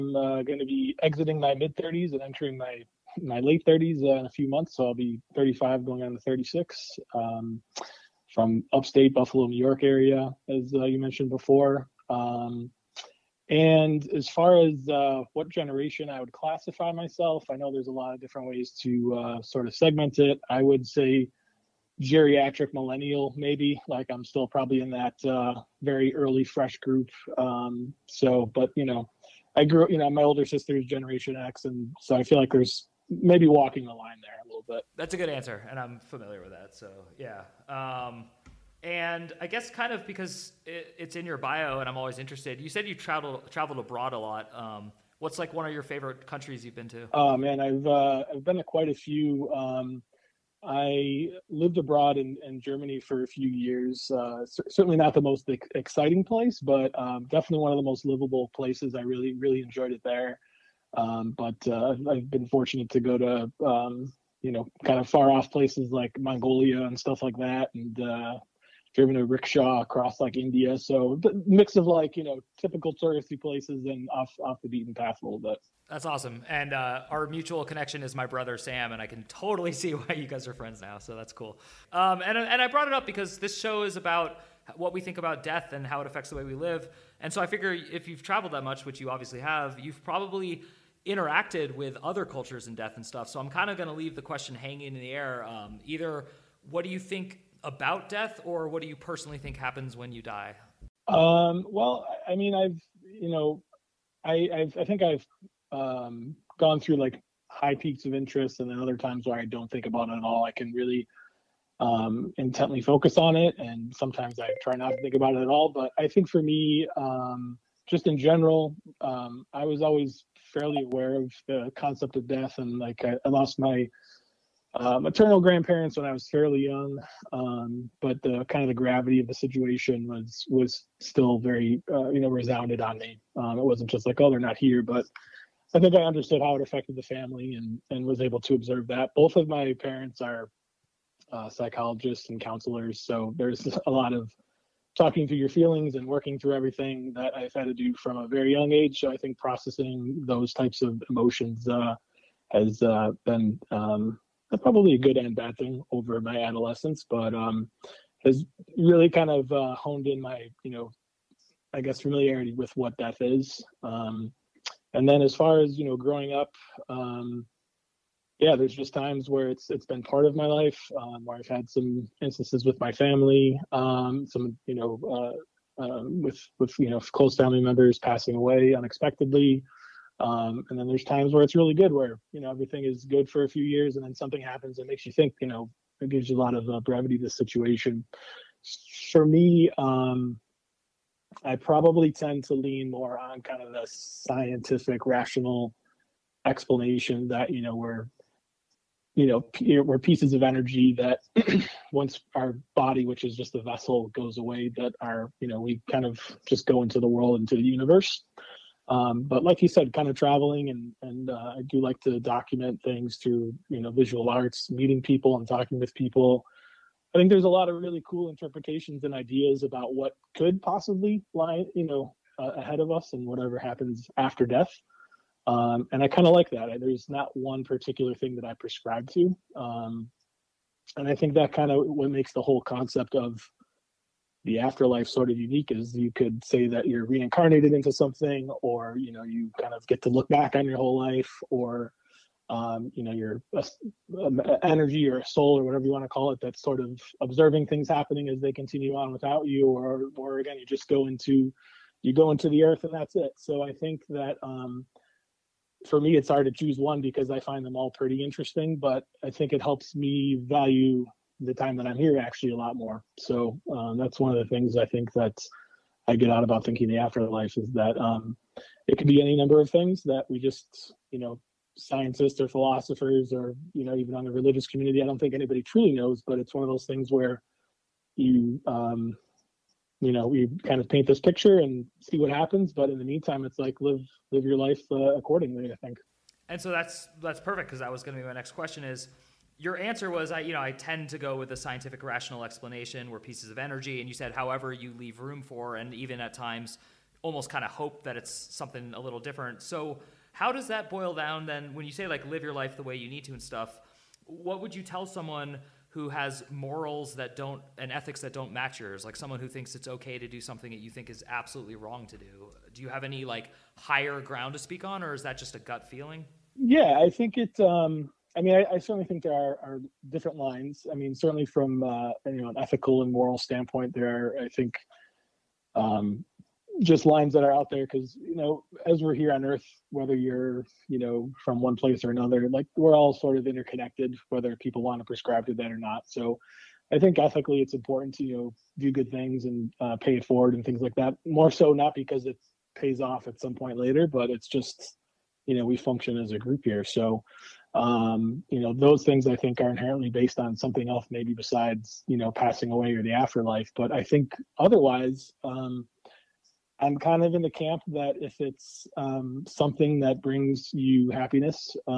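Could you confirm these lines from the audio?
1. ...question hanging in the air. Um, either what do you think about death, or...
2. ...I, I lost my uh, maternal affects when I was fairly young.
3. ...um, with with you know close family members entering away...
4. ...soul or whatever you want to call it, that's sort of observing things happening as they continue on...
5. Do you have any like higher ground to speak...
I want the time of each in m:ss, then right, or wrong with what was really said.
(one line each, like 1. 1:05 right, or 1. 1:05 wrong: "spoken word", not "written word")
1. 1:34 right
2. 2:03 wrong: "grandparents", not "affects"
3. 2:55 wrong: "passing", not "entering"
4. 4:05 right
5. 5:12 right.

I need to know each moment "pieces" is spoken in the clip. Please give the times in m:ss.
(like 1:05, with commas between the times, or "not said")
3:19, 4:53.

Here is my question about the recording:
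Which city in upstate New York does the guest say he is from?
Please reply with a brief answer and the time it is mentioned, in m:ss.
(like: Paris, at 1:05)
Buffalo, at 0:09.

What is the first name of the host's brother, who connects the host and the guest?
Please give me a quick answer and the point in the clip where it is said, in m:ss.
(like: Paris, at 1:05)
Sam, at 1:18.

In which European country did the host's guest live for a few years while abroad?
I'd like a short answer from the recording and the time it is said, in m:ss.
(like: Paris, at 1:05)
Germany, at 0:52.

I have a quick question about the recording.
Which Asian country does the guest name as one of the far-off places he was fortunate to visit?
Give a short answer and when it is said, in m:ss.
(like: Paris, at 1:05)
Mongolia, at 1:06.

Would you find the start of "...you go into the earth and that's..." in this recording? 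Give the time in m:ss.
4:12.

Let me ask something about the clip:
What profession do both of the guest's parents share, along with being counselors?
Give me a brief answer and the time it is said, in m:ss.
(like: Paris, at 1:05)
Psychologists, at 2:21.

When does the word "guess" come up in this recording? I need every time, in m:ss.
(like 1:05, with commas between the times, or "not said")
0:39, 2:41.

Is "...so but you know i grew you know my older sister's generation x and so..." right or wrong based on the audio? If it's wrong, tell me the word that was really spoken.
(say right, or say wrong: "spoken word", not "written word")
right.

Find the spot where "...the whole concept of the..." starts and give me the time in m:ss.
3:52.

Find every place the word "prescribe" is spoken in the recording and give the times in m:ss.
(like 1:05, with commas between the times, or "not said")
3:48, 5:35.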